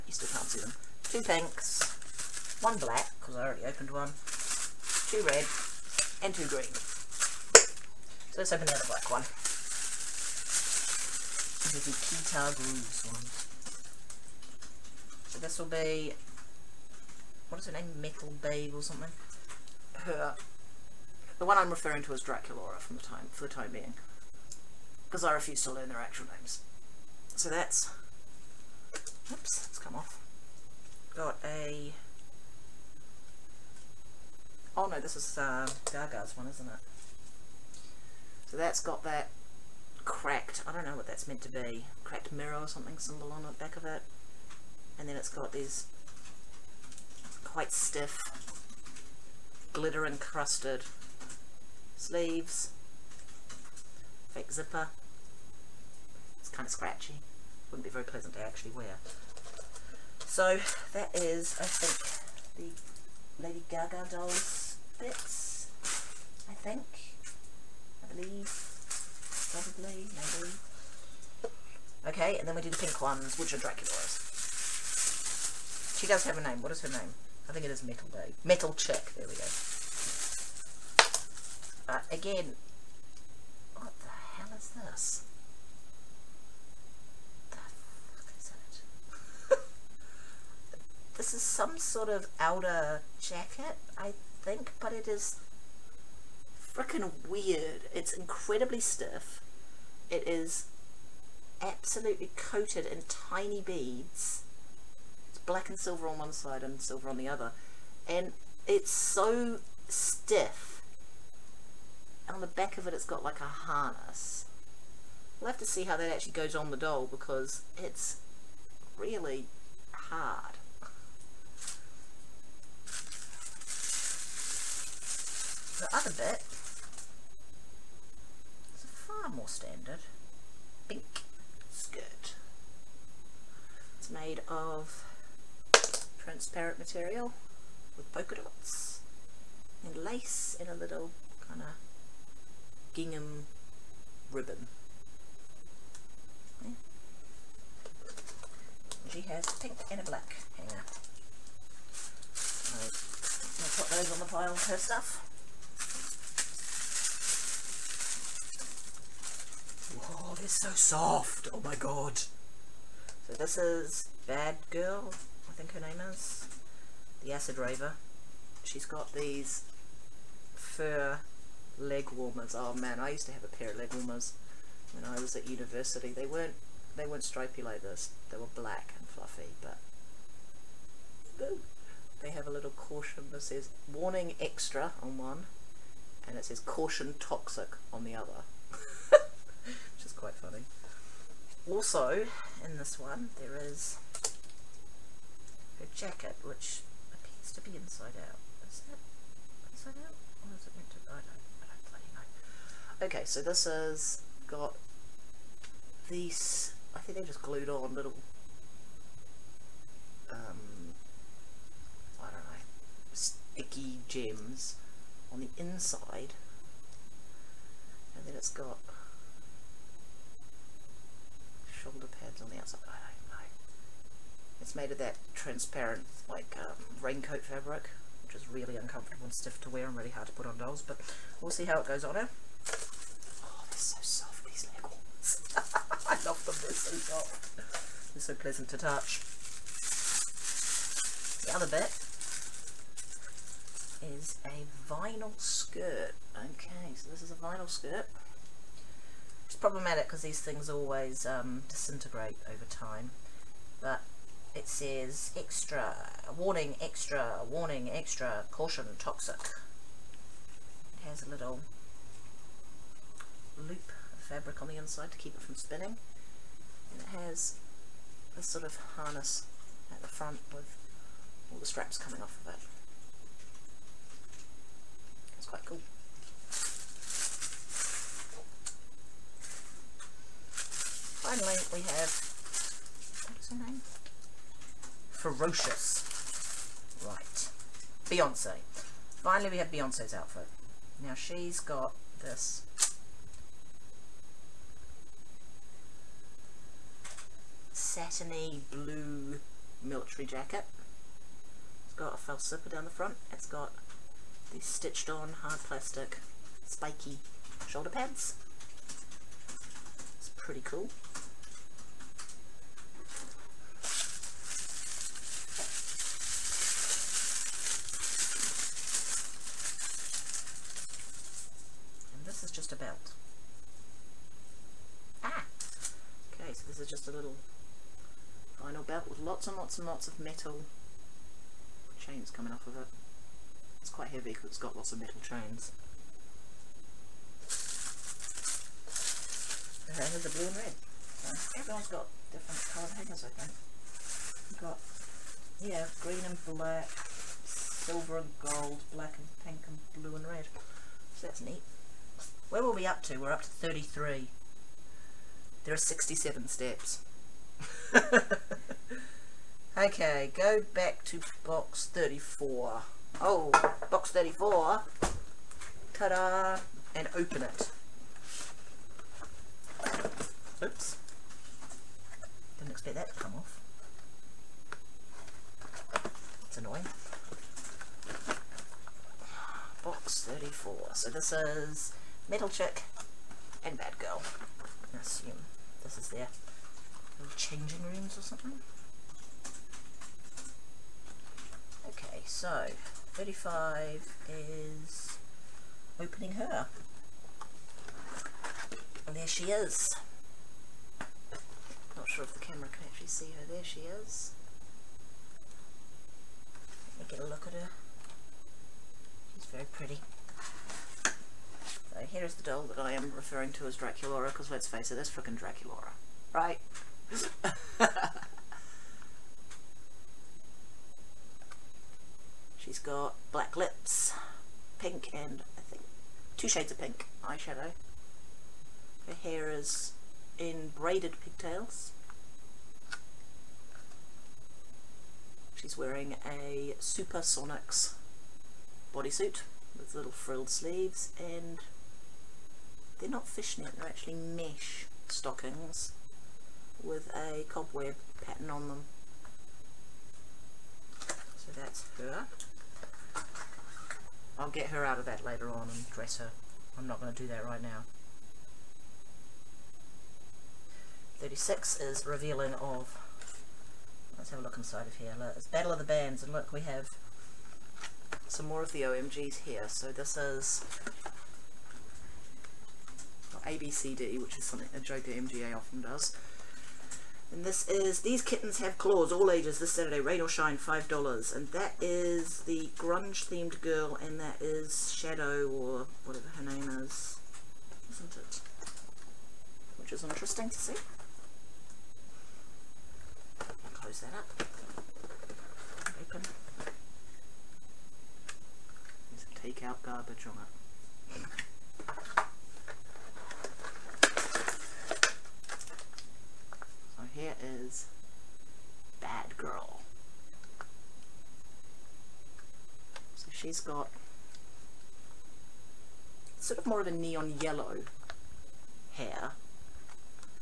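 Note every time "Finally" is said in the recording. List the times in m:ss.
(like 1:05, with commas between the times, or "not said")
4:41, 4:49.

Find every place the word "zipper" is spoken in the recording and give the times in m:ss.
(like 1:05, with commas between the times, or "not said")
0:54, 5:02.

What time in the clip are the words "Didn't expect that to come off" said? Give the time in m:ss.
6:12.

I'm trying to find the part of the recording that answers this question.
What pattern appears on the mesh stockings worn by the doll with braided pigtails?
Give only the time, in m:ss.
7:27.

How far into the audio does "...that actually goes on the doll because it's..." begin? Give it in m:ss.
1:55.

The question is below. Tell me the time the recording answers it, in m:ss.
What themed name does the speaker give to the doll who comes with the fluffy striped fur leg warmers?
2:47.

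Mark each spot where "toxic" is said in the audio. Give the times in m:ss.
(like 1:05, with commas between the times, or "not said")
3:07, 4:18.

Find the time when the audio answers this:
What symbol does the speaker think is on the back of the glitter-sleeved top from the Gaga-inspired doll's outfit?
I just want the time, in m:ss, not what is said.
0:42.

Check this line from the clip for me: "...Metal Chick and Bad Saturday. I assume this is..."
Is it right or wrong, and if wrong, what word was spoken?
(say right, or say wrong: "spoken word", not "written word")
wrong: "Girl", not "Saturday".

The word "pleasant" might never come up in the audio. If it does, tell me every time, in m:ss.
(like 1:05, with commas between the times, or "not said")
0:58, 3:58.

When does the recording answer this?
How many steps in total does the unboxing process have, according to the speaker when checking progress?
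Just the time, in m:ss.
5:55.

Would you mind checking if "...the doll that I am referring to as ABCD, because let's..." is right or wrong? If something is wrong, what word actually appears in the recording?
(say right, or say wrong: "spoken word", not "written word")
wrong: "Draculaura", not "ABCD".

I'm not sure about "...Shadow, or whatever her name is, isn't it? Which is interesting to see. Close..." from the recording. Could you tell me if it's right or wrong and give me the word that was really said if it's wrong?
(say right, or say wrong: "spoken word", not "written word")
right.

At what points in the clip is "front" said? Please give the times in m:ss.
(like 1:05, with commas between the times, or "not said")
4:30, 5:02.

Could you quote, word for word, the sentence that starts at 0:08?
So let's open the other black one.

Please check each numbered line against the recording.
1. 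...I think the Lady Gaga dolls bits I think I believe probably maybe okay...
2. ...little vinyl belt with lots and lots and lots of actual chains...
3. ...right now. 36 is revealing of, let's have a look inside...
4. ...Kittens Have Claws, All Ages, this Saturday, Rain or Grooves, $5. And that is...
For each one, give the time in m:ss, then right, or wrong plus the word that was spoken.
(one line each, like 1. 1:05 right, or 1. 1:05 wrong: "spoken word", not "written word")
1. 1:01 right
2. 5:27 wrong: "metal", not "actual"
3. 7:37 right
4. 7:58 wrong: "Shine", not "Grooves".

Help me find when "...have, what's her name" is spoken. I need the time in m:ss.
4:41.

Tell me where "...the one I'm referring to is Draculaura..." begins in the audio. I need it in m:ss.
0:21.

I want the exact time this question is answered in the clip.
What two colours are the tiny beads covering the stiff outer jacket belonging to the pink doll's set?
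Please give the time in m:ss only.
1:45.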